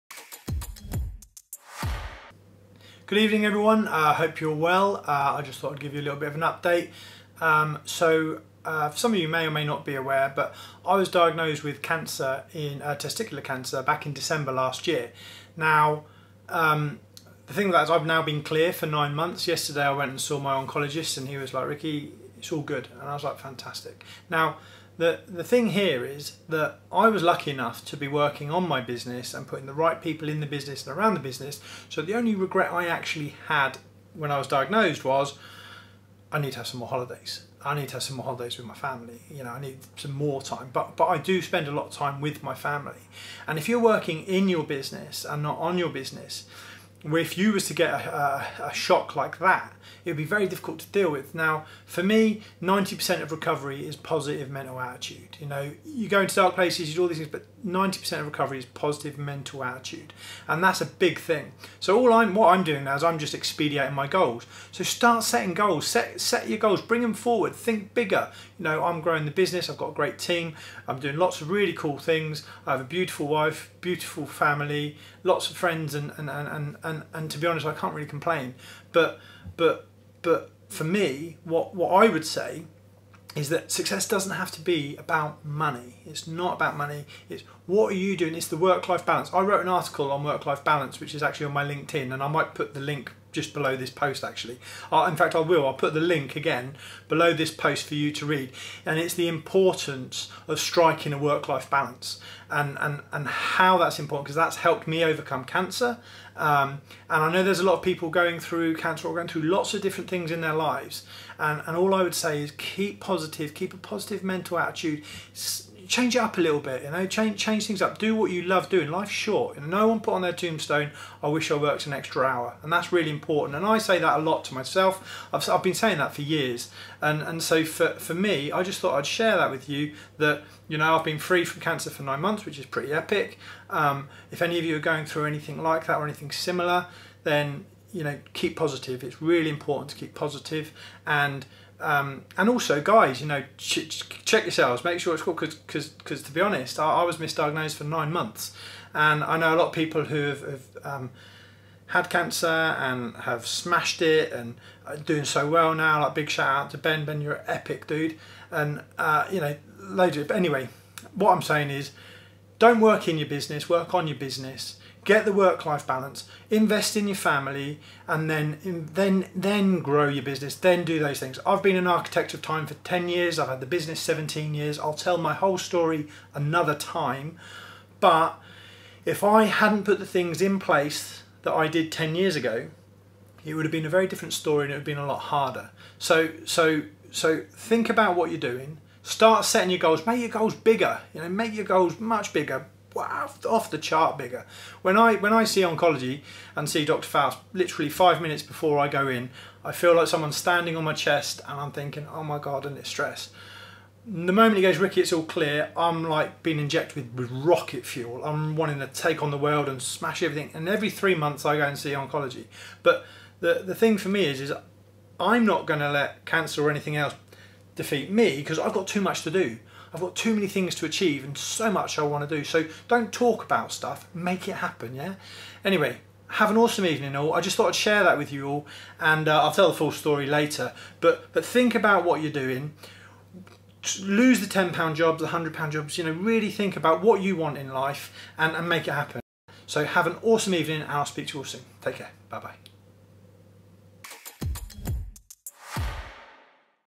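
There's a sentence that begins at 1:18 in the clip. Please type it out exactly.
But but but for me, what, what I would say is that success doesn't have to be about money.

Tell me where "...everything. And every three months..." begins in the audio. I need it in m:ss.
3:30.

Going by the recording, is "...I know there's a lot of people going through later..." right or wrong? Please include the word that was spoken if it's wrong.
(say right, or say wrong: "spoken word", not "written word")
wrong: "cancer", not "later".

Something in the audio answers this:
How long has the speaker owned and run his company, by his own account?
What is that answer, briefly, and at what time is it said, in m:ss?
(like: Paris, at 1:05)
17 years, at 2:53.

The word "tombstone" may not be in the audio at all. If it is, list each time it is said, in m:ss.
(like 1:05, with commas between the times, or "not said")
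2:00.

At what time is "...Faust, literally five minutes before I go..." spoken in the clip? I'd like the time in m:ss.
3:17.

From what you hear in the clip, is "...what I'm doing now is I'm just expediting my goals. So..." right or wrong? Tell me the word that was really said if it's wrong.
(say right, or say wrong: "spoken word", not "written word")
right.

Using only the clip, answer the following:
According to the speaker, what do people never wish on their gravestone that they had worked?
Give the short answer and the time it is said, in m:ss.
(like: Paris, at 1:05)
An extra hour, at 2:01.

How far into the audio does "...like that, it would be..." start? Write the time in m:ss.
0:49.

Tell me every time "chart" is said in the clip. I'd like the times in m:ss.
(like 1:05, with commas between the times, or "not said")
3:13.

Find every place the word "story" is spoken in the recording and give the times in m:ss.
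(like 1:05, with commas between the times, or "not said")
2:55, 3:04, 3:49.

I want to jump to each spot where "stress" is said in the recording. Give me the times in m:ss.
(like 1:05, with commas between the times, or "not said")
3:22.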